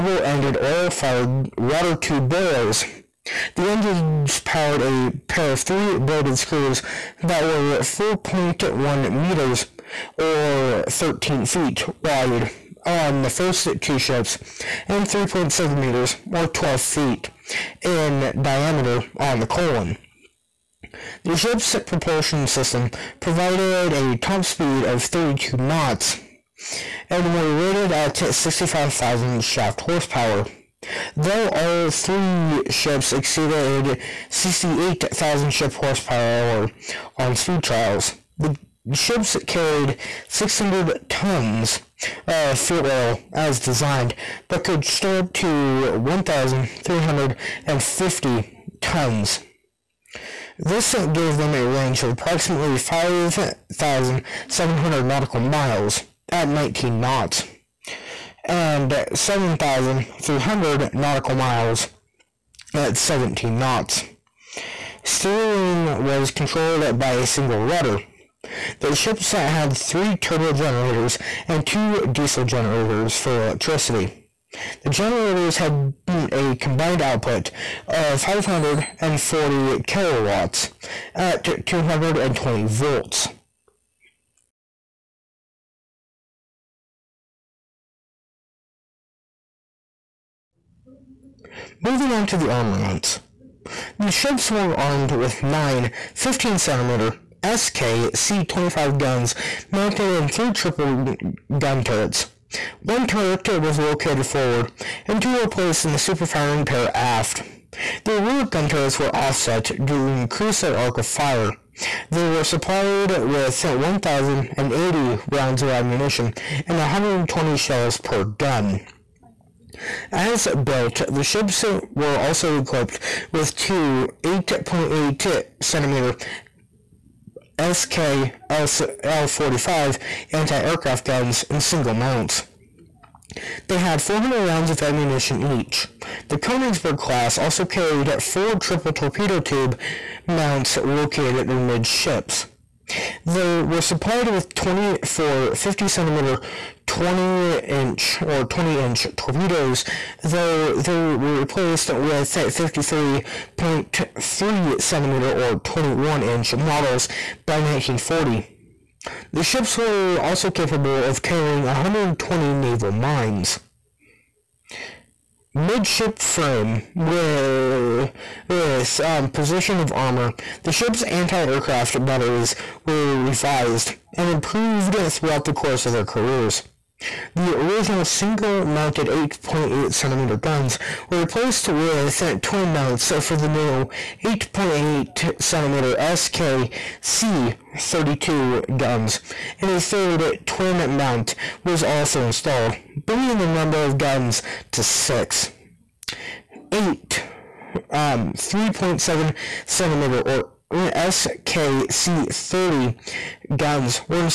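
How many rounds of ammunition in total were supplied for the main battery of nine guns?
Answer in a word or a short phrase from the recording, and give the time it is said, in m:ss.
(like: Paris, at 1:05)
1,080, at 1:53.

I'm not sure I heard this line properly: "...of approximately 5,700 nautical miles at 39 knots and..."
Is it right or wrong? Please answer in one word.
wrong.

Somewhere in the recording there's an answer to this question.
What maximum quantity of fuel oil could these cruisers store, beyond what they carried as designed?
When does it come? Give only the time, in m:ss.
0:45.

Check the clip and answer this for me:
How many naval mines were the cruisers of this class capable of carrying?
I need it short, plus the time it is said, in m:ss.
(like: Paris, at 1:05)
120, at 2:41.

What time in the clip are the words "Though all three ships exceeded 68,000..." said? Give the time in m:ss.
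0:31.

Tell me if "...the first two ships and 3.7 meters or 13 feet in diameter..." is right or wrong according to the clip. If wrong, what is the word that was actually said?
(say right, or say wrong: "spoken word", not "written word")
wrong: "12", not "13".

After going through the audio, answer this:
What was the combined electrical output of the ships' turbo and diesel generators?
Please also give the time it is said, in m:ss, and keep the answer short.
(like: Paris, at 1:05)
540 kilowatts, at 1:18.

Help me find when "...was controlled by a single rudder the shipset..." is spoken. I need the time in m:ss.
1:06.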